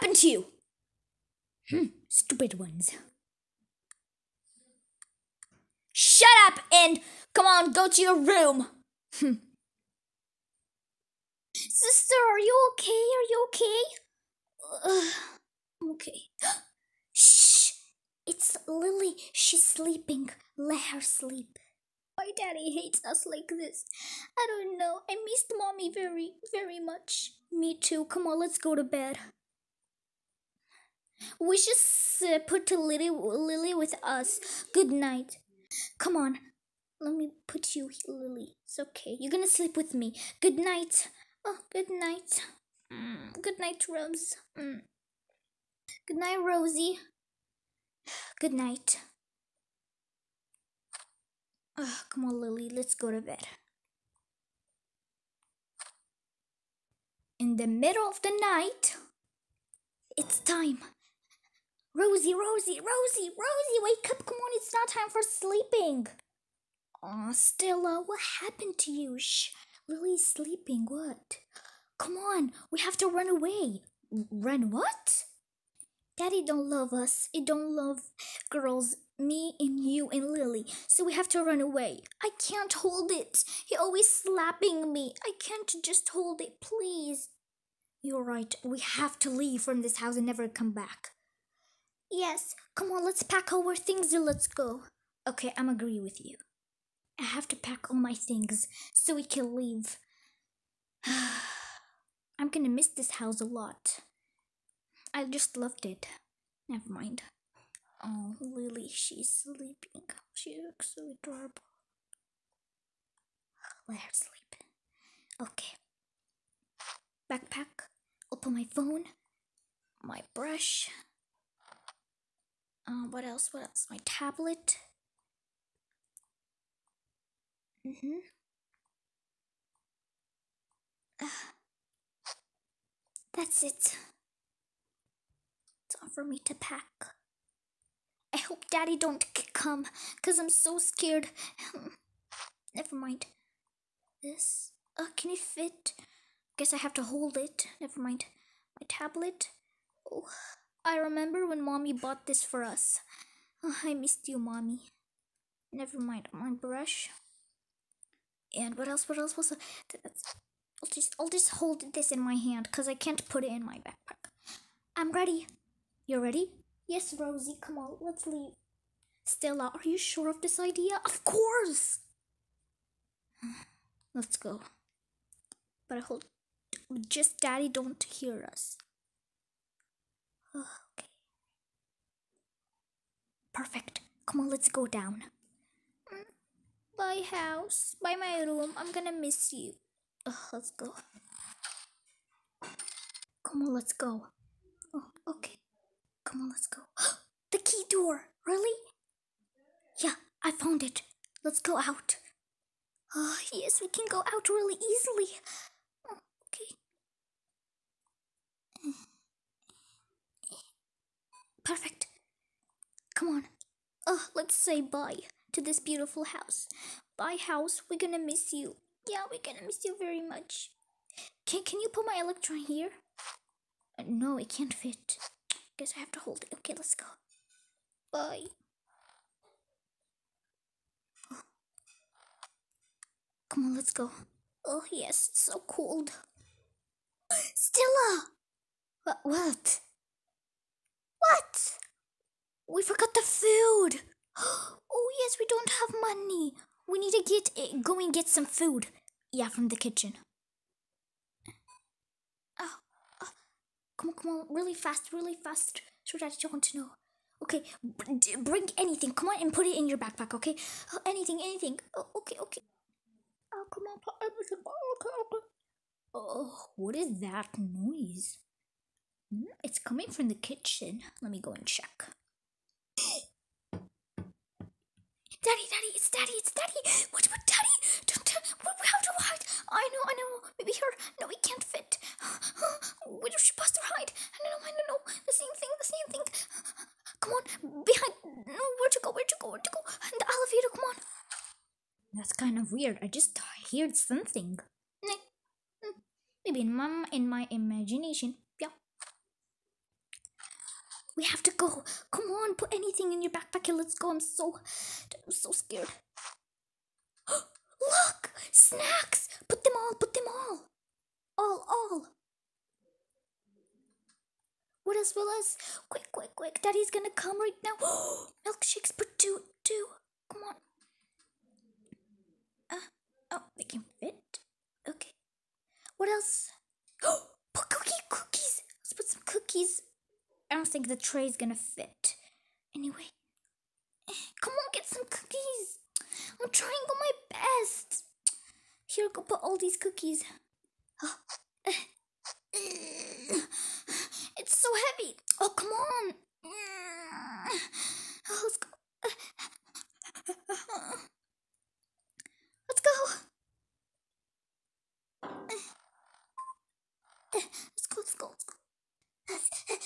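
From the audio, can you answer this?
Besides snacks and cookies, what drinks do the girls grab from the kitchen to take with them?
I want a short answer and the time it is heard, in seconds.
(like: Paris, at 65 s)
milkshakes, at 318 s.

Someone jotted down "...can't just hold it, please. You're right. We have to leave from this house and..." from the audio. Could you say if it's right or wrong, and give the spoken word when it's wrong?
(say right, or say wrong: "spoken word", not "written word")
right.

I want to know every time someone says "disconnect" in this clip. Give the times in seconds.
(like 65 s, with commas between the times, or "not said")
not said.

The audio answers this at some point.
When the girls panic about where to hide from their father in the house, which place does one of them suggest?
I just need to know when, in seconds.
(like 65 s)
290 s.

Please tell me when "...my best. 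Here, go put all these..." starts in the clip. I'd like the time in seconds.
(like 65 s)
336 s.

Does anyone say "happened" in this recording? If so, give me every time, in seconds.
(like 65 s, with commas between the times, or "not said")
68 s.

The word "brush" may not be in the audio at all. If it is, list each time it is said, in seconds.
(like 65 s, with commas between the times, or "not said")
120 s, 156 s.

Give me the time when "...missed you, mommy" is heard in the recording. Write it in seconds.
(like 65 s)
153 s.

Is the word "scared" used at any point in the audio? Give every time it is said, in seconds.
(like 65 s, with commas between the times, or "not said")
140 s, 305 s.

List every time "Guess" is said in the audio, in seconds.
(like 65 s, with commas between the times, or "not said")
146 s, 225 s.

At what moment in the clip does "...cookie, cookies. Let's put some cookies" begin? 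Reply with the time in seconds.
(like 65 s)
327 s.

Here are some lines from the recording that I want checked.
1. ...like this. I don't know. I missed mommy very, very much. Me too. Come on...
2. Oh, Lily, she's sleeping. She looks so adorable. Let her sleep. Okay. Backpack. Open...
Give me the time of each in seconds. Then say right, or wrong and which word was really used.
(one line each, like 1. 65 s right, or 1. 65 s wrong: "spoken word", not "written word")
1. 23 s right
2. 108 s right.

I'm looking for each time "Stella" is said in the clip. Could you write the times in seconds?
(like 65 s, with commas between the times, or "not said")
67 s, 169 s, 237 s.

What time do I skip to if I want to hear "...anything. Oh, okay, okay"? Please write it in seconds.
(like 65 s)
261 s.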